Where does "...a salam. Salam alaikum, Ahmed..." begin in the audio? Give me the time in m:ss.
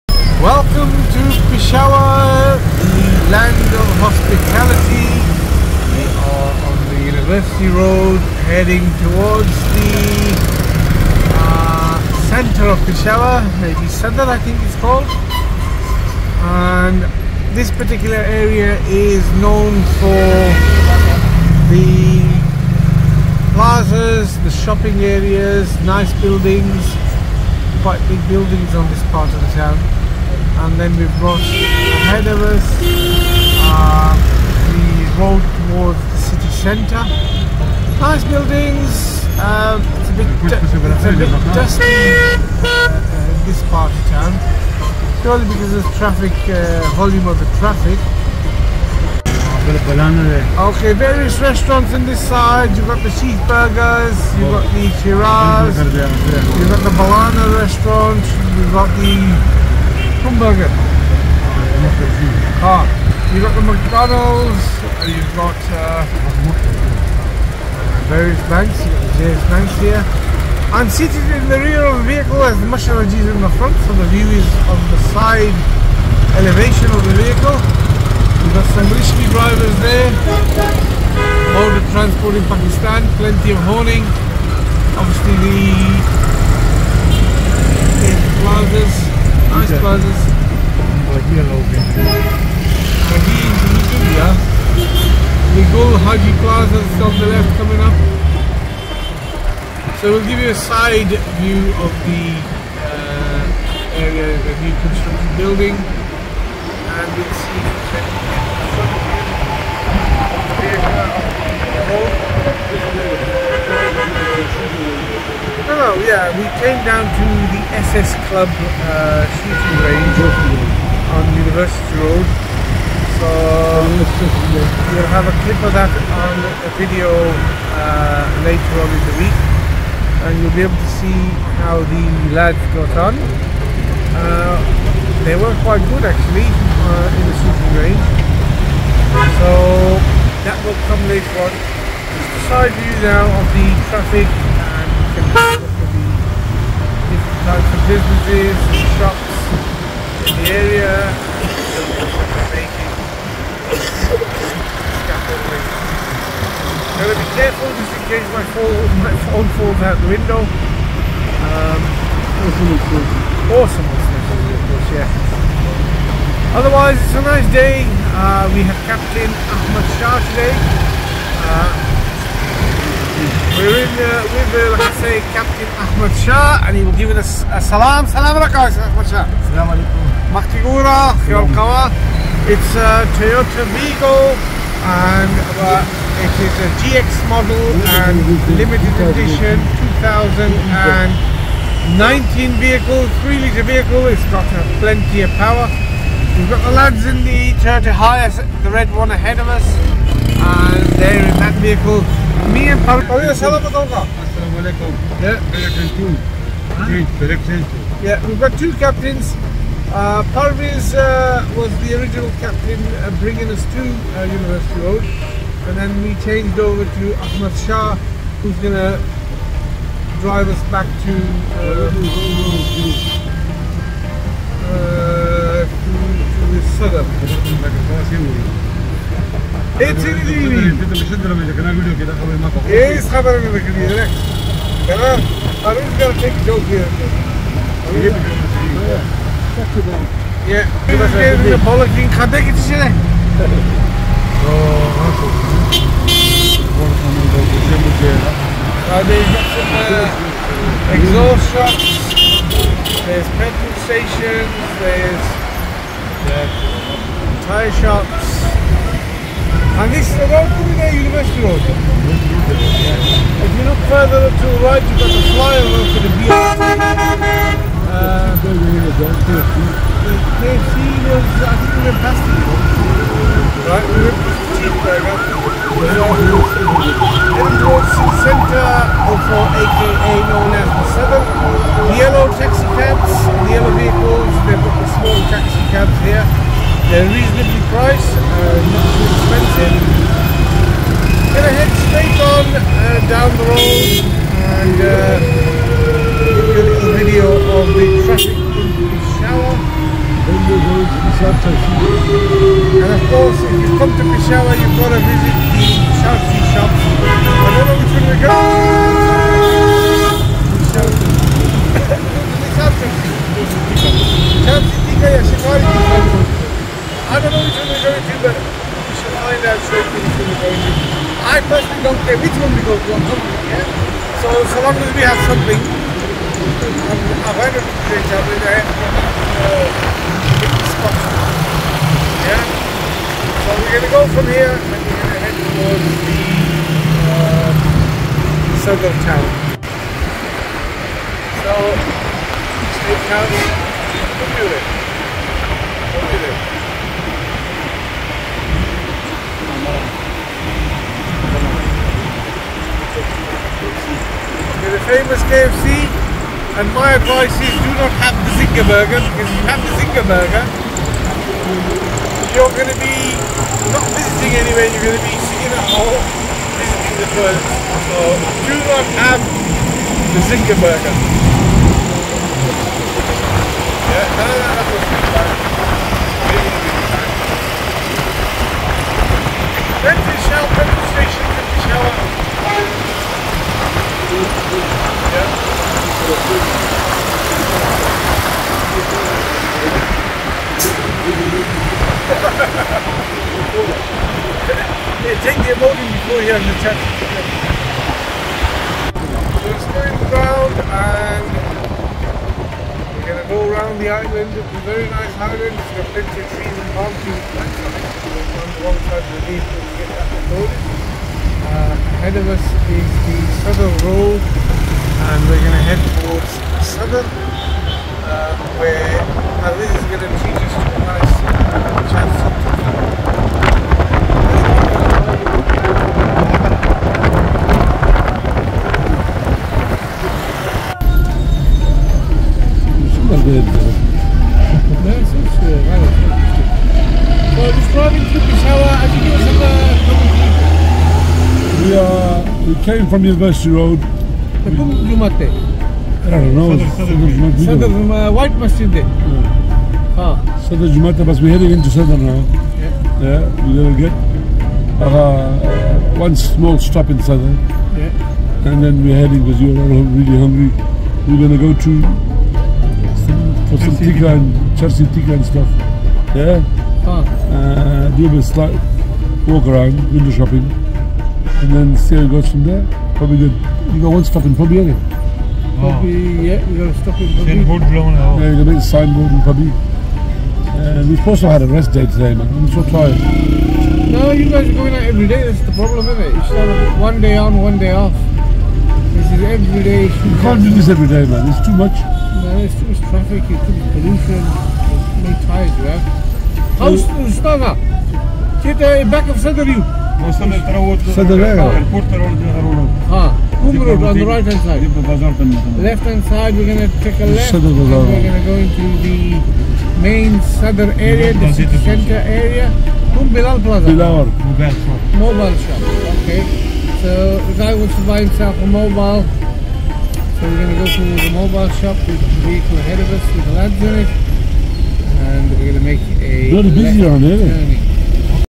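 2:57.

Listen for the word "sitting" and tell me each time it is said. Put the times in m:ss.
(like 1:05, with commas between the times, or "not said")
6:05.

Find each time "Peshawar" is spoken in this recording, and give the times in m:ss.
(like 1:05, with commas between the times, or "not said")
0:01, 0:12, 5:04.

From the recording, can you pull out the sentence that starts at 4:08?
Kade exhaust shocks, there's petrol stations, there's tire shops, And this is road to the University Road.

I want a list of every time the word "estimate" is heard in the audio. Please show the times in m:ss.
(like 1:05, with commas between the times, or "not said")
not said.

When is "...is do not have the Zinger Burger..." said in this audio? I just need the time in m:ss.
5:57.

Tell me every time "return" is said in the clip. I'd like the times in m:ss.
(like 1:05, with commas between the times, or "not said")
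not said.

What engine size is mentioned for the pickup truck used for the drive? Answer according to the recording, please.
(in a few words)
3 litre.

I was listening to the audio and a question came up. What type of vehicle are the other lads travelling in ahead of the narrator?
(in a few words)
Toyota Hiace.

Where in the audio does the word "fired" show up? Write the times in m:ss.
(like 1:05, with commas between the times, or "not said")
not said.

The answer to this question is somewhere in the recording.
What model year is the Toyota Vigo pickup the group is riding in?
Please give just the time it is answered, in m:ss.
3:09.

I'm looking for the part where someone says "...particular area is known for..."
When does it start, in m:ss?
0:17.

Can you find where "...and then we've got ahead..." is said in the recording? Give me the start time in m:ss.
0:30.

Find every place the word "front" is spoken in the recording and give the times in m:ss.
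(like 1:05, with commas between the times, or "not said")
1:13, 1:54.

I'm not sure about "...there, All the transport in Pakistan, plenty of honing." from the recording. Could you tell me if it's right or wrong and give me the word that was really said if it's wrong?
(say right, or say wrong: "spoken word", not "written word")
right.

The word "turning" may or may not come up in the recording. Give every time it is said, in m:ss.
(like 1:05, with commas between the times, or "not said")
not said.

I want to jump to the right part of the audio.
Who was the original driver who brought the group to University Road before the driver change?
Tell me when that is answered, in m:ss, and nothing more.
3:30.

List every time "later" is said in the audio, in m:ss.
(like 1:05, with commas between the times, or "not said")
2:08, 2:21.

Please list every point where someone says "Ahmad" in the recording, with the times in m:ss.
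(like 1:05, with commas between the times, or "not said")
2:49, 3:37.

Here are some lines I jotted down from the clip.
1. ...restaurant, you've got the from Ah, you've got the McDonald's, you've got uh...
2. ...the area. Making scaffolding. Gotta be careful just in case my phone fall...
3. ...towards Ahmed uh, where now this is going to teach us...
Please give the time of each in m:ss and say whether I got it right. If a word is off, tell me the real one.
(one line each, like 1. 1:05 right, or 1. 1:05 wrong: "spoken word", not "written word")
1. 0:57 right
2. 2:30 right
3. 6:55 wrong: "Saddar", not "Ahmed".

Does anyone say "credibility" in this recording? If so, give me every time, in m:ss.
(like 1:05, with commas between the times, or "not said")
not said.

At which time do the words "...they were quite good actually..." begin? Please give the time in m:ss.
2:15.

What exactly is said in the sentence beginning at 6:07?
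So do not have the Zinger Burger.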